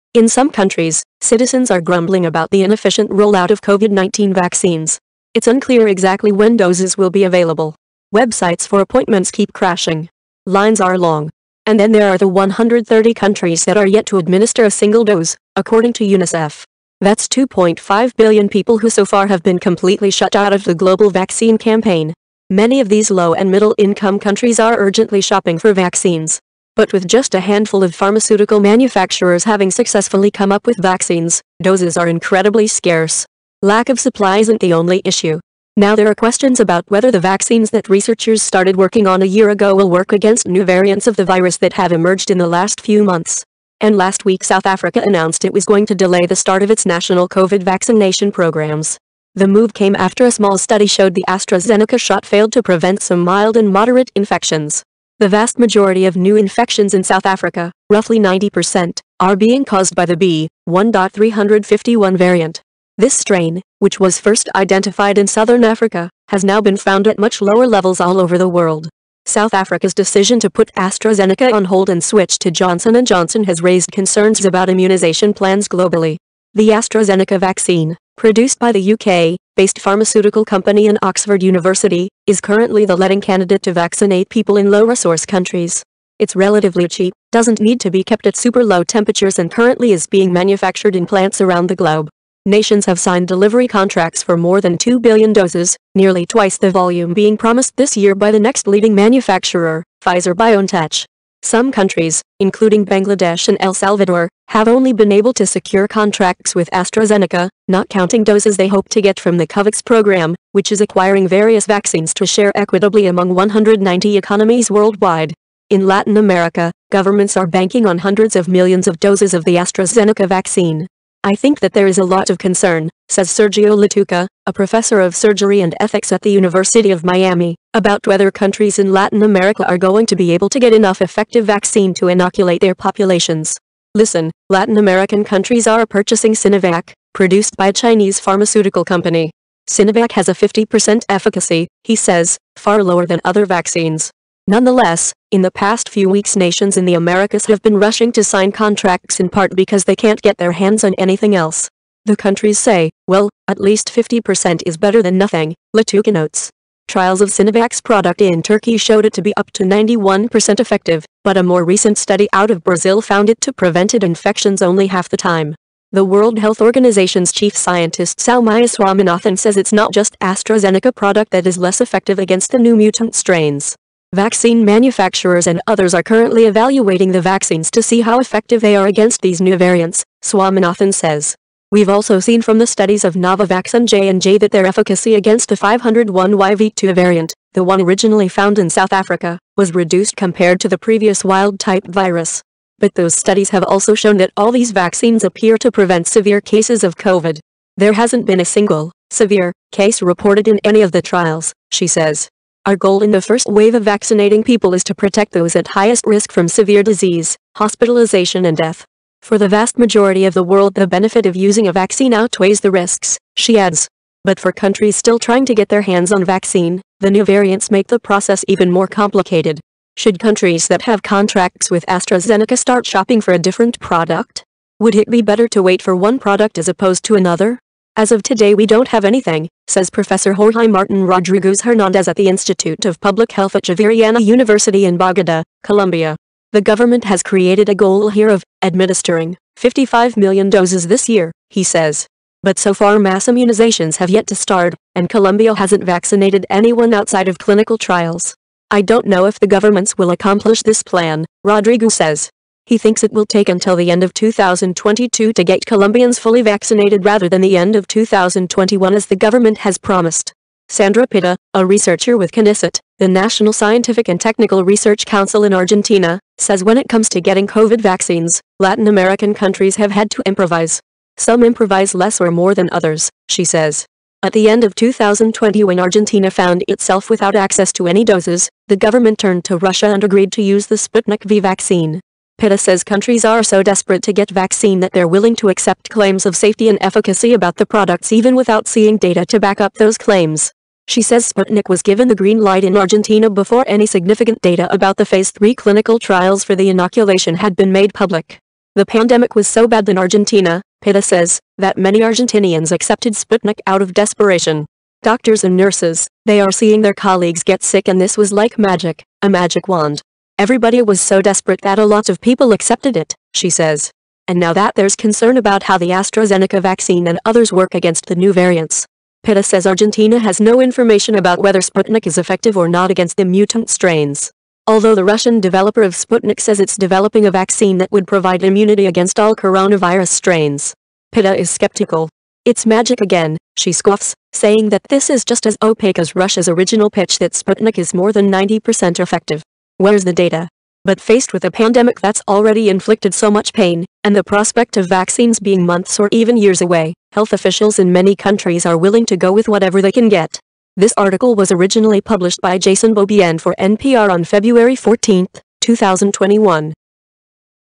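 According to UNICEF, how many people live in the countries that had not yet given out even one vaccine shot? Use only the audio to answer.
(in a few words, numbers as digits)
2.5 billion.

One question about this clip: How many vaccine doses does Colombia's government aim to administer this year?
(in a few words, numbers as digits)
55 million.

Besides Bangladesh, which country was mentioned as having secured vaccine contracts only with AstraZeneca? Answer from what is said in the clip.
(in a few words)
El Salvador.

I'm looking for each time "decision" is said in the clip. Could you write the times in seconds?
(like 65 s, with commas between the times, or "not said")
69 s.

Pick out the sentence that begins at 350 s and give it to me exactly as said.
This article was originally published by Jason Beaubien for NPR on February 14, 2021.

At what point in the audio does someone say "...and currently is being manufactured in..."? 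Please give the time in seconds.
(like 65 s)
89 s.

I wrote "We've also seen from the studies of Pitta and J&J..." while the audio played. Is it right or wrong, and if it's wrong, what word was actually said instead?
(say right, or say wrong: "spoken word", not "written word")
wrong: "Novavax", not "Pitta".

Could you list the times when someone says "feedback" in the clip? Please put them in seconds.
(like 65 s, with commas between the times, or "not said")
not said.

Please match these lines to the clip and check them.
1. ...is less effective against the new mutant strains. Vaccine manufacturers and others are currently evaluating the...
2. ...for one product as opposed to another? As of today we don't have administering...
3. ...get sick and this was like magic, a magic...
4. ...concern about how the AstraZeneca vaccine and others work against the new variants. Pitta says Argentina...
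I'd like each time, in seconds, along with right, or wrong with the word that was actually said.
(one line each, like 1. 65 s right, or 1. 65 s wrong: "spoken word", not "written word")
1. 171 s right
2. 225 s wrong: "anything", not "administering"
3. 307 s right
4. 314 s right.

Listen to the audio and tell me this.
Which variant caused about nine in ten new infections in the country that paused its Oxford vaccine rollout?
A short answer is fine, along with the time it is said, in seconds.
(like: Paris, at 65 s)
B.1.351, at 60 s.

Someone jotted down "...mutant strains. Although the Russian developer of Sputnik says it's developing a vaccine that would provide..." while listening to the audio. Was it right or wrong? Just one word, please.
right.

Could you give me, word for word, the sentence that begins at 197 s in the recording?
There hasn't been a single, severe, case reported in any of the trials, she says.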